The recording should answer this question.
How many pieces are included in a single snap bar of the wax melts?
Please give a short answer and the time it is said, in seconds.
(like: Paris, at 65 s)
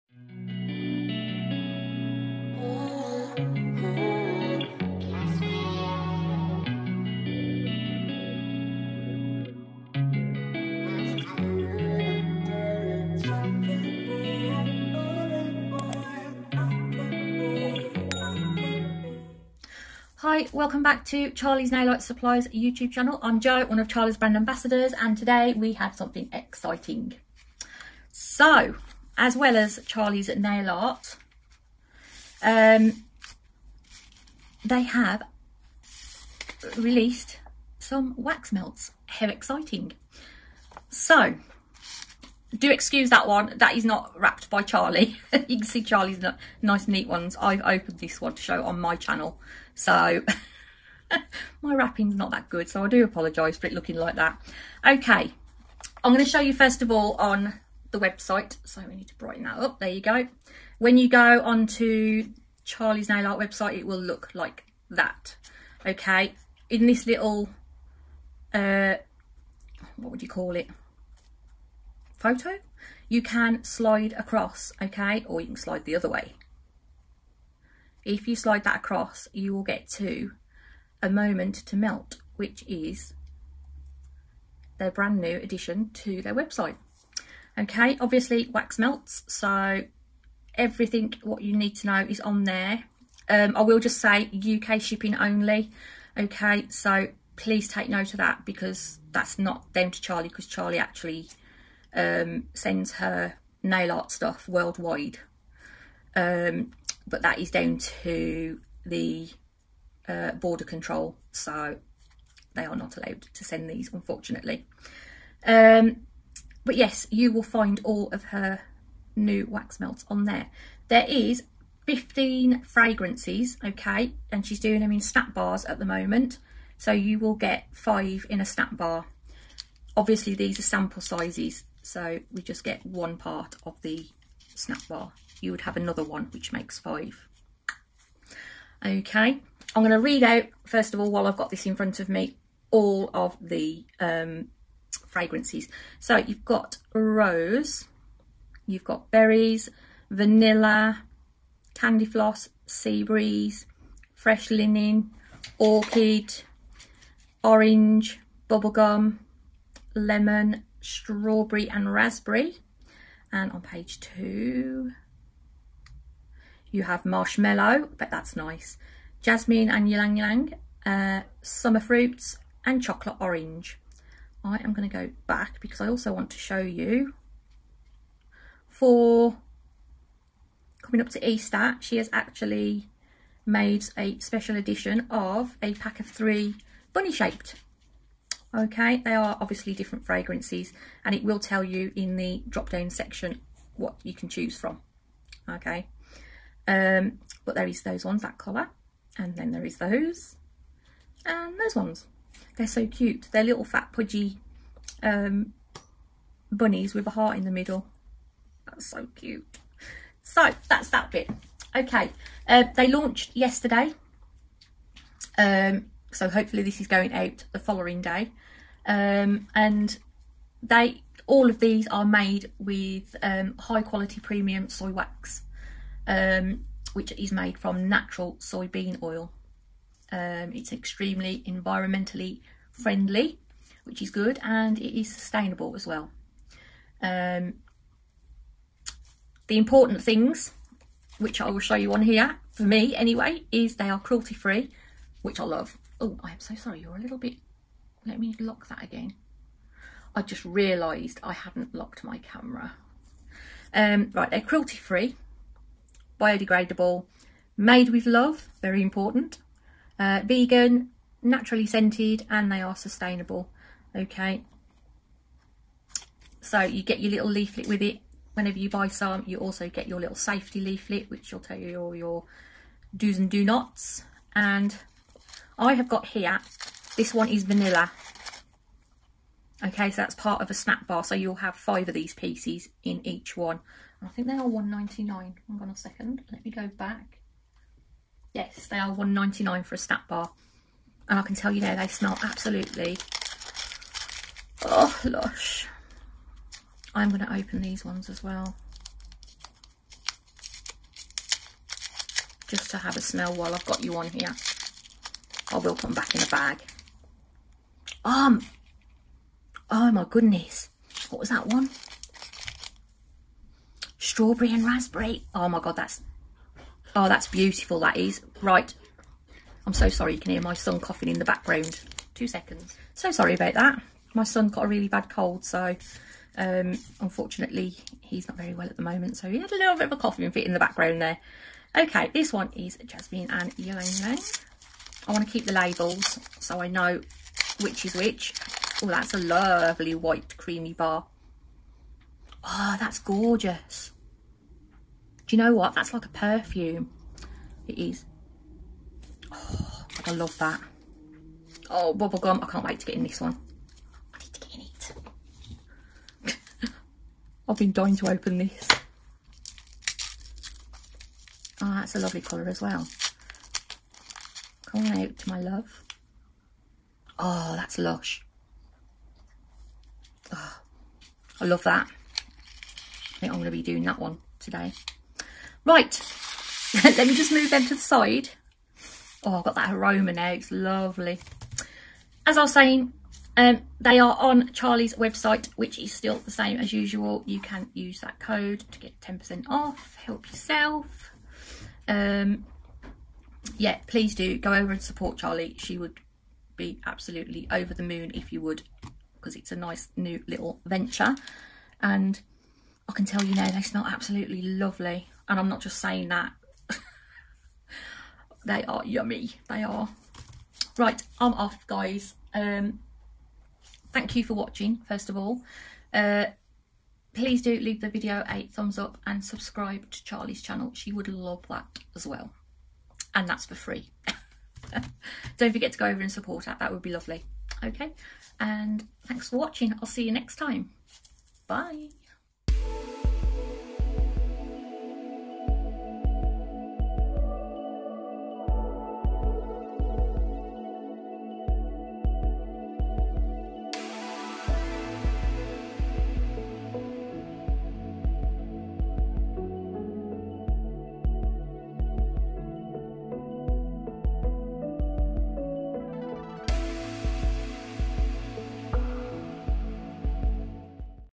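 5, at 127 s.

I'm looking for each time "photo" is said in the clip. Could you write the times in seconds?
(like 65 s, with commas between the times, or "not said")
72 s.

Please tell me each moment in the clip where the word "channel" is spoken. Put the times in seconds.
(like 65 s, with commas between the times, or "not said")
22 s, 48 s, 420 s.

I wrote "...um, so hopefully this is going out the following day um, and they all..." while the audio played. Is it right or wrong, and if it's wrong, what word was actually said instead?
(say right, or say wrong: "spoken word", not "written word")
right.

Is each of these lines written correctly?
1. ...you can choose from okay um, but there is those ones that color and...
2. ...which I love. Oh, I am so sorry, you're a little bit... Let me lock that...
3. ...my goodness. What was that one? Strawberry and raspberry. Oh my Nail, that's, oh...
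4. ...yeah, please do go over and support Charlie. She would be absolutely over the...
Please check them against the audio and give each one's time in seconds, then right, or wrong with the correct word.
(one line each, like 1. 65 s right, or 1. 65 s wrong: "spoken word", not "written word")
1. 194 s right
2. 245 s right
3. 309 s wrong: "God", not "Nail"
4. 393 s right.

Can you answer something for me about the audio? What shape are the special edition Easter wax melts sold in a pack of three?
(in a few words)
Bunny.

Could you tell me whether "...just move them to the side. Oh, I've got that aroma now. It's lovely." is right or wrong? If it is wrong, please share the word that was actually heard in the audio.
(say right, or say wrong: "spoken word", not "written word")
right.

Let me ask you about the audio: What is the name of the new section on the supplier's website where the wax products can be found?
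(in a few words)
Moment to Melt.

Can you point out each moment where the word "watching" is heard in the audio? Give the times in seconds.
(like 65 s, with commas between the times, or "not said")
414 s, 429 s.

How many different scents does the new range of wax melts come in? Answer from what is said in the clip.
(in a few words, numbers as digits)
15.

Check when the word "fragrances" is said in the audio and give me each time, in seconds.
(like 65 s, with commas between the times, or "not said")
122 s, 145 s, 190 s.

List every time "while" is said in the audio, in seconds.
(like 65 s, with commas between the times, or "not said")
141 s, 303 s.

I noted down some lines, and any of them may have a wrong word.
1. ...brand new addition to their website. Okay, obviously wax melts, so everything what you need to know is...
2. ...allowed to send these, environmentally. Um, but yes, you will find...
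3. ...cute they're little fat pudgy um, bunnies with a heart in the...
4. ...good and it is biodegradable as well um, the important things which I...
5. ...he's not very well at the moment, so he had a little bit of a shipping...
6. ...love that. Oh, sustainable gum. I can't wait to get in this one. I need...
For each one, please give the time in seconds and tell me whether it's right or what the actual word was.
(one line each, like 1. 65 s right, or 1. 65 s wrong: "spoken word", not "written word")
1. 84 s right
2. 112 s wrong: "unfortunately", not "environmentally"
3. 202 s right
4. 234 s wrong: "sustainable", not "biodegradable"
5. 327 s wrong: "coughing", not "shipping"
6. 350 s wrong: "bubble", not "sustainable".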